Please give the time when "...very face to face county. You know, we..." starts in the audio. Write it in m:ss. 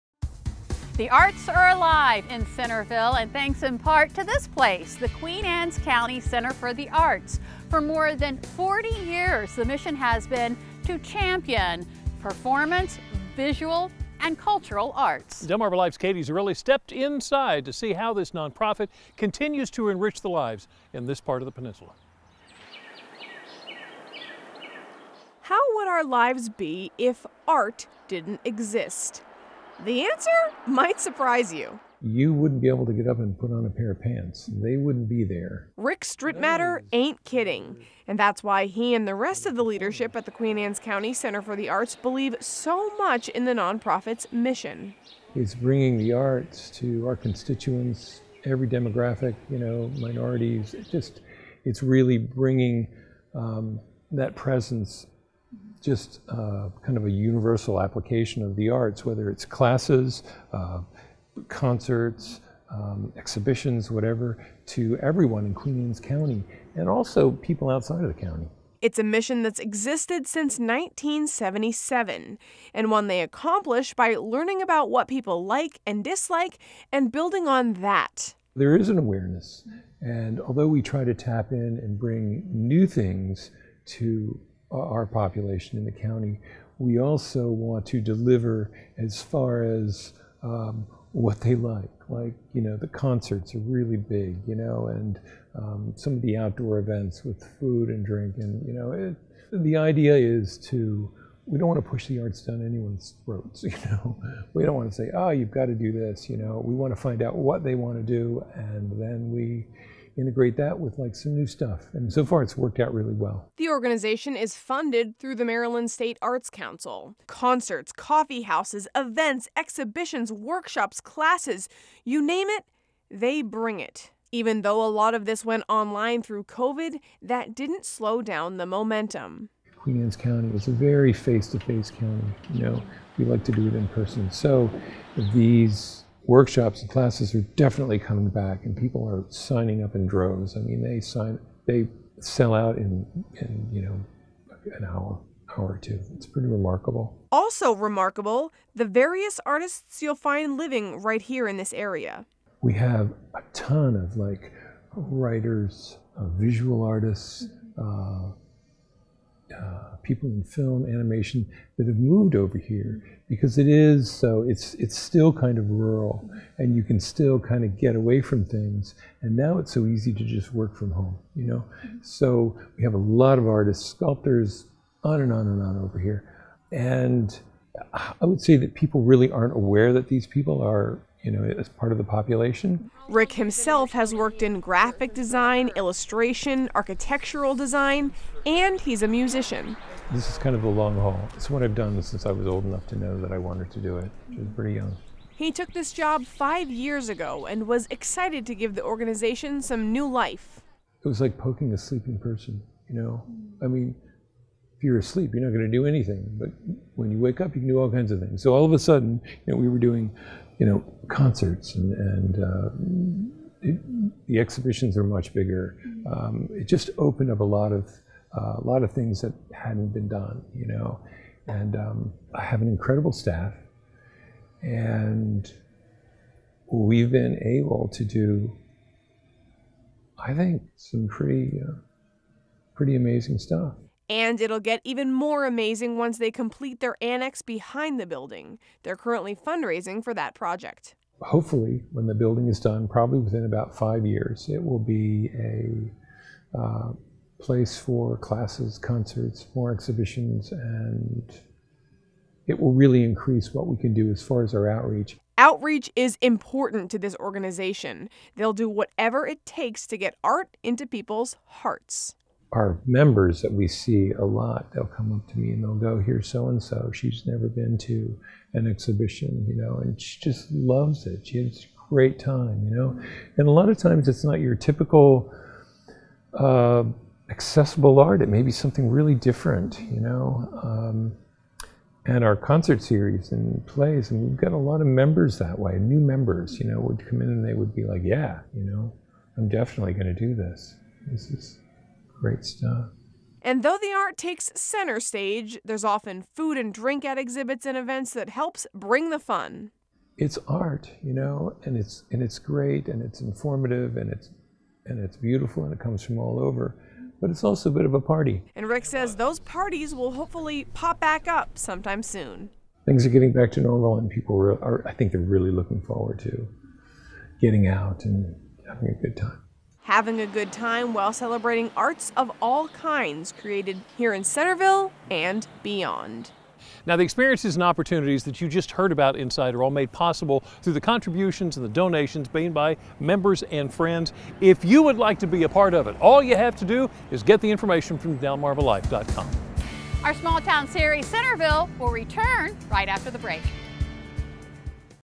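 2:10.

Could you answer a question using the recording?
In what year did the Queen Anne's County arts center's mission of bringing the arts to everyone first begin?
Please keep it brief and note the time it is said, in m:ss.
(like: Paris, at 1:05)
1977, at 1:10.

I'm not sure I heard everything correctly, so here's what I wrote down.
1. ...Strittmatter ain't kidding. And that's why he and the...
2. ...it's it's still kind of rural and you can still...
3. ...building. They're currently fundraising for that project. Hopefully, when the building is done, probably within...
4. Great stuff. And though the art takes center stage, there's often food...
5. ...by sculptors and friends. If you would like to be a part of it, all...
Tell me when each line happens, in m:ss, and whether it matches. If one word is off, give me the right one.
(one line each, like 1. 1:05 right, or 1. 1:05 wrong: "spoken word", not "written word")
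1. 0:36 right
2. 2:44 right
3. 3:58 right
4. 4:52 right
5. 5:32 wrong: "members", not "sculptors".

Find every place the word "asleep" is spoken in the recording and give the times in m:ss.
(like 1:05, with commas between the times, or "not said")
3:24.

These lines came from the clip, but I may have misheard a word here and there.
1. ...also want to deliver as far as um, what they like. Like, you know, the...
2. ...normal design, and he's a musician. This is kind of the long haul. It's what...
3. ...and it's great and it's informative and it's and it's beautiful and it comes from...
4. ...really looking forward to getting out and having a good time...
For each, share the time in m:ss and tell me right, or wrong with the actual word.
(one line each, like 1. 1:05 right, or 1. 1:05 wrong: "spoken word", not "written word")
1. 1:26 right
2. 3:06 wrong: "architectural", not "normal"
3. 5:02 right
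4. 5:15 right.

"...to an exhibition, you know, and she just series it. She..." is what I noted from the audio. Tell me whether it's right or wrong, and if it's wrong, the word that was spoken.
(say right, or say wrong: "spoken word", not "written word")
wrong: "loves", not "series".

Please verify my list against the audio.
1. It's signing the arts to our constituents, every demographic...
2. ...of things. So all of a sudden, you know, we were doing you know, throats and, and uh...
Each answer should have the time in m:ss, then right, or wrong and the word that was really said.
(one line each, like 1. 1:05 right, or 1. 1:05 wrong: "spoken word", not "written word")
1. 0:45 wrong: "bringing", not "signing"
2. 3:28 wrong: "concerts", not "throats".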